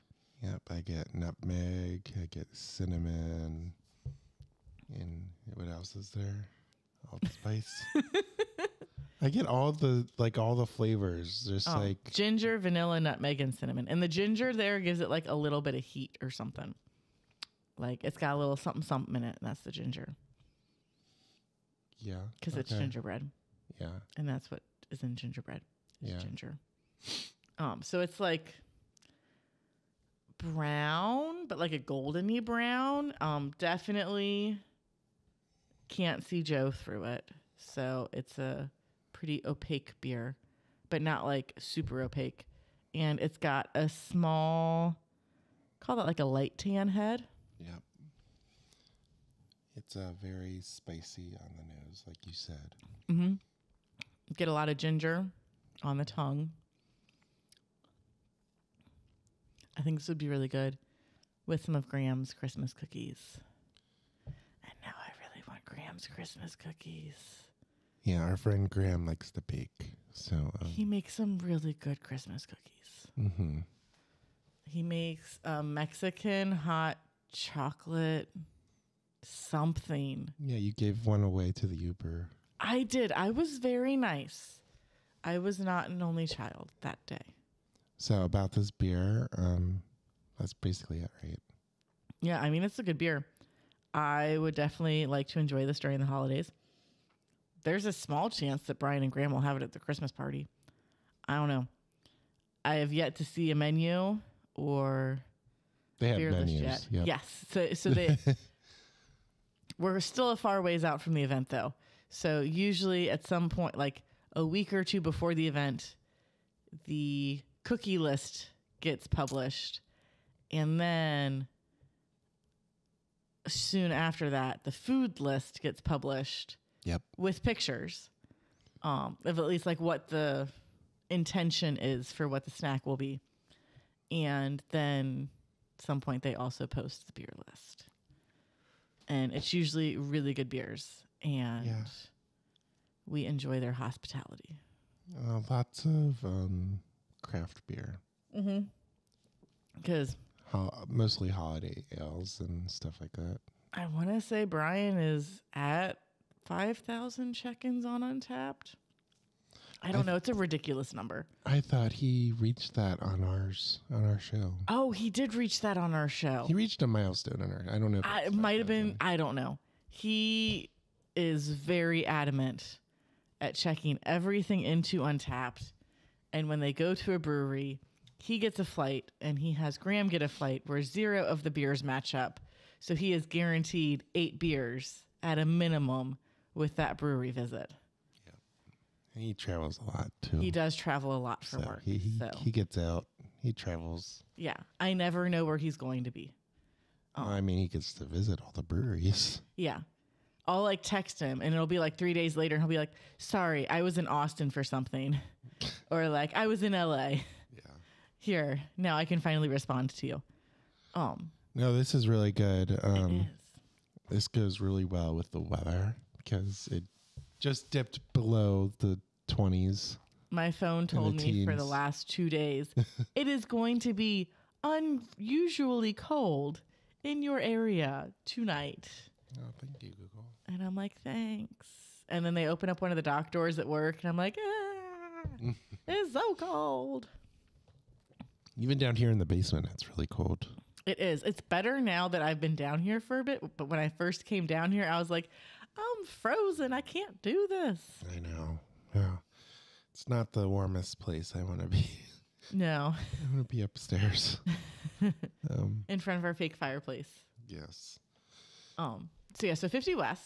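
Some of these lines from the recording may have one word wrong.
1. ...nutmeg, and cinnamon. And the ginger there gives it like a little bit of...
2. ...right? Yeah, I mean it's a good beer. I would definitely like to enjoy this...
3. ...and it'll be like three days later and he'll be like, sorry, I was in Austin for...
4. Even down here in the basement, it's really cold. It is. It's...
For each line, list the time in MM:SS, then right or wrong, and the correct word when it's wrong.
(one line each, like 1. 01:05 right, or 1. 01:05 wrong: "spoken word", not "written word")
1. 00:13 right
2. 01:31 right
3. 03:21 right
4. 03:58 right.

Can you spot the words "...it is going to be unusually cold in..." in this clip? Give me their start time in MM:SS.
03:43.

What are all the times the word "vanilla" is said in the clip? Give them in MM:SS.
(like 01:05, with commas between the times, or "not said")
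00:12.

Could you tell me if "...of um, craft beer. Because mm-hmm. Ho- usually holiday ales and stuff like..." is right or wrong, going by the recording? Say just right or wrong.
wrong.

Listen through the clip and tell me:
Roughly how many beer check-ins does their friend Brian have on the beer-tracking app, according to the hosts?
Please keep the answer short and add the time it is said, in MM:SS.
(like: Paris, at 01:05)
5,000, at 02:36.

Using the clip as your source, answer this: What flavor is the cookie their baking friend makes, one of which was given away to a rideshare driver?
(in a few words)
Mexican hot chocolate.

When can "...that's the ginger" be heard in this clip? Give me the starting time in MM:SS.
00:19.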